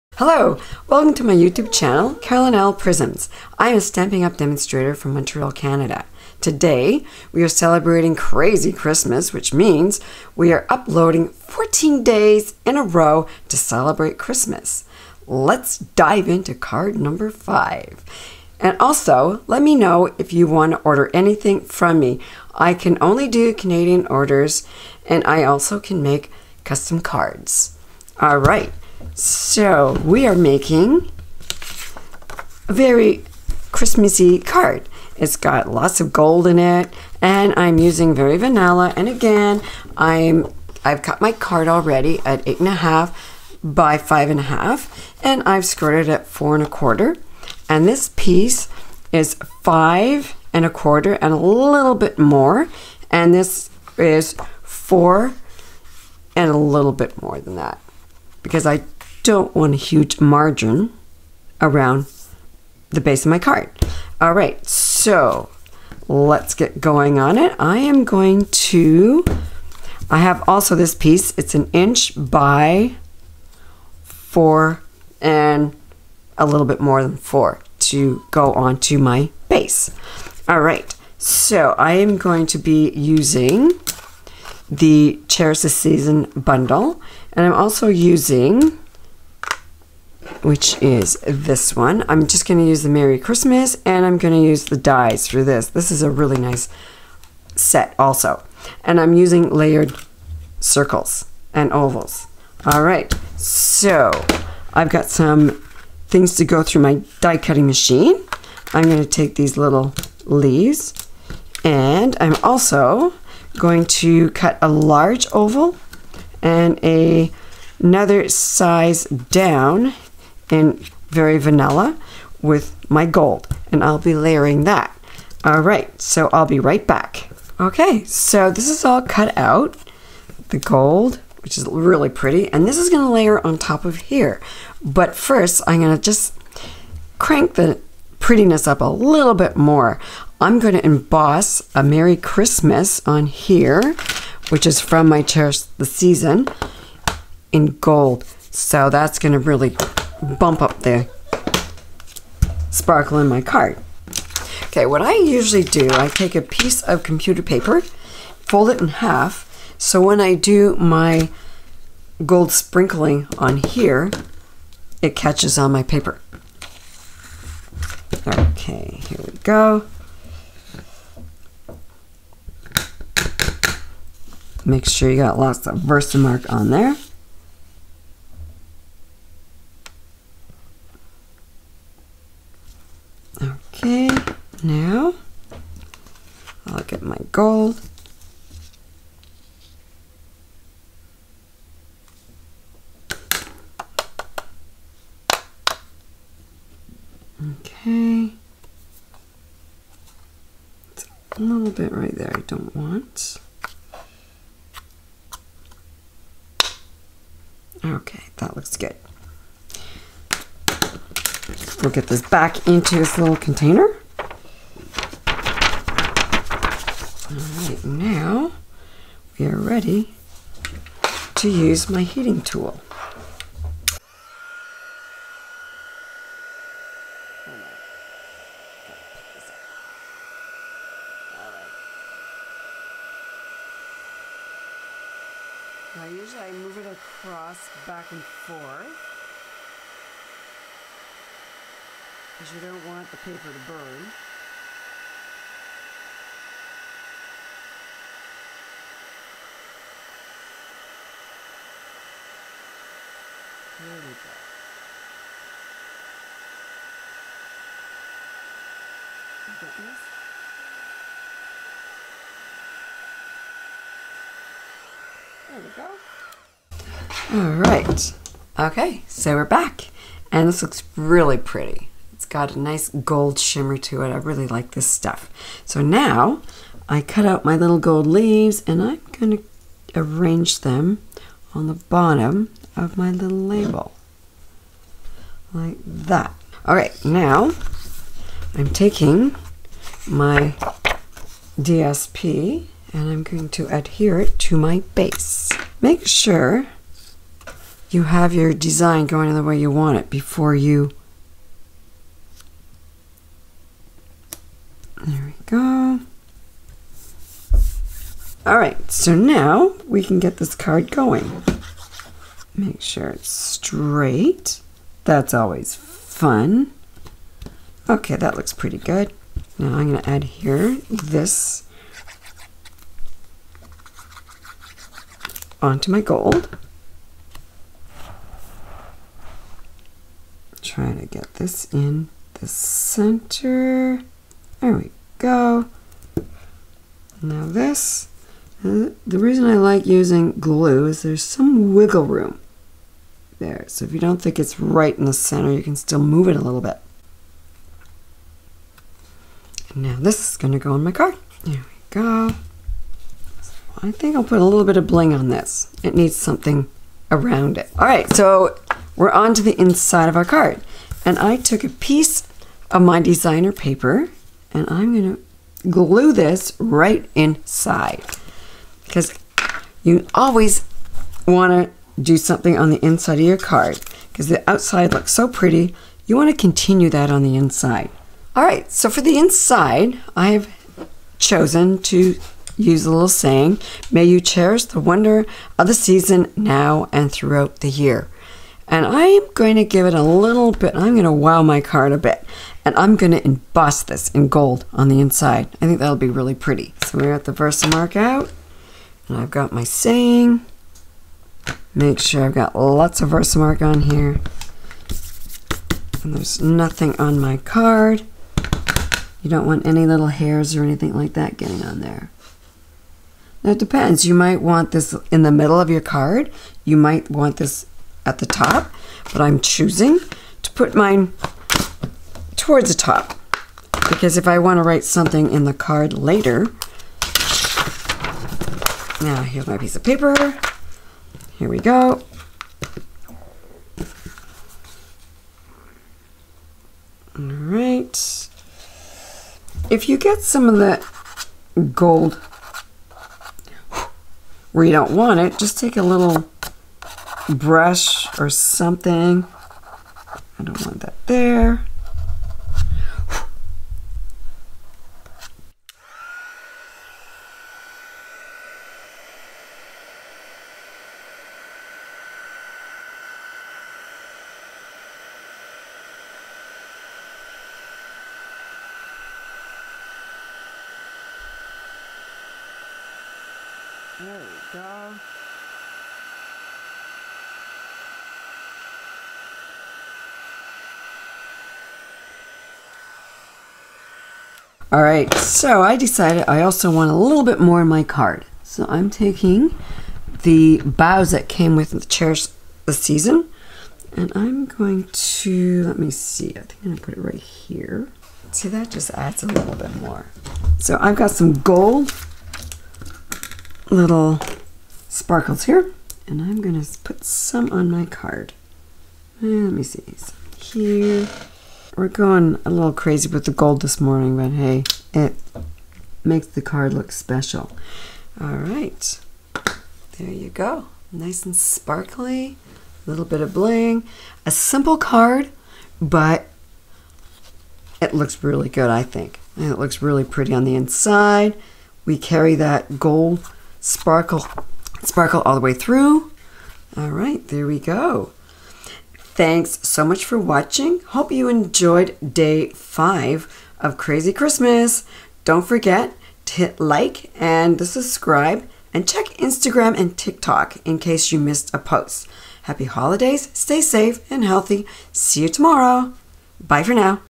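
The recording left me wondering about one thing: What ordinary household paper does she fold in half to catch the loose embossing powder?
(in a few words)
computer paper.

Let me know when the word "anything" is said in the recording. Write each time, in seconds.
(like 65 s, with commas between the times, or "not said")
21 s, 410 s.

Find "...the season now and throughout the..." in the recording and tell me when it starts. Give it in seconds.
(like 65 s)
385 s.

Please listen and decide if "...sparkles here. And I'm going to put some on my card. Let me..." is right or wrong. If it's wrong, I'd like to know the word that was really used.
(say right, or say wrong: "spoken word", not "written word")
right.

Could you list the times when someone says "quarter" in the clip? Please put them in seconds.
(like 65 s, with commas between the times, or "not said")
46 s, 50 s.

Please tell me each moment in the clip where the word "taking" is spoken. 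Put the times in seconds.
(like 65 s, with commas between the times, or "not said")
288 s, 488 s.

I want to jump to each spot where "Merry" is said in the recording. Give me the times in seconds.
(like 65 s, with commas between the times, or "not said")
92 s, 141 s.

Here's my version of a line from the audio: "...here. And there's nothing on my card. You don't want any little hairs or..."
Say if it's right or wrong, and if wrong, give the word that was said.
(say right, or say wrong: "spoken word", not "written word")
right.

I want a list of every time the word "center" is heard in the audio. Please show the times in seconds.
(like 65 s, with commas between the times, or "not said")
332 s, 345 s.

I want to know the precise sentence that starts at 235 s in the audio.
Now usually I move it across back and forth because you don't want the paper to burn.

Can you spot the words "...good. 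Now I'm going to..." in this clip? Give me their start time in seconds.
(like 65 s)
318 s.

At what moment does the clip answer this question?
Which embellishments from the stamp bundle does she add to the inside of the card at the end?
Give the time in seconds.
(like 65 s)
490 s.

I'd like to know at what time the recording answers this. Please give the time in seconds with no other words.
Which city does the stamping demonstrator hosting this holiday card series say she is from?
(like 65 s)
5 s.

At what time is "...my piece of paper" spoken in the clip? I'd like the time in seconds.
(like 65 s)
429 s.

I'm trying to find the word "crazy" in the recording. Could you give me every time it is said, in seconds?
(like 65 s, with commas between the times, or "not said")
8 s, 512 s, 543 s.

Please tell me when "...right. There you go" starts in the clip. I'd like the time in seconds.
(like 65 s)
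518 s.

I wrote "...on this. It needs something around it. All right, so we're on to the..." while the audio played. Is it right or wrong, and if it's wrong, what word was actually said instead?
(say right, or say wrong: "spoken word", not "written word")
right.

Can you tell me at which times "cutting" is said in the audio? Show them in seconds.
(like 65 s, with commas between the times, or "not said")
107 s.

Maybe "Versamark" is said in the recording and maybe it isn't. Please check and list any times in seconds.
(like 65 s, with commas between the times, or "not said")
175 s, 397 s, 403 s.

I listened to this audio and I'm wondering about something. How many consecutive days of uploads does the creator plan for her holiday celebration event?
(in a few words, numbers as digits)
14.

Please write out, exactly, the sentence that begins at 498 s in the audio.
See, that just adds a little bit more.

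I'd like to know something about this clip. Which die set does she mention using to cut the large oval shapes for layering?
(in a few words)
layered circles and ovals.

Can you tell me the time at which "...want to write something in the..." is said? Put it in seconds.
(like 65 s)
424 s.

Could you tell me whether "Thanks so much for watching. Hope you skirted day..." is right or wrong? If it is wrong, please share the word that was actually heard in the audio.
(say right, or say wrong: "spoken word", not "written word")
wrong: "enjoyed", not "skirted".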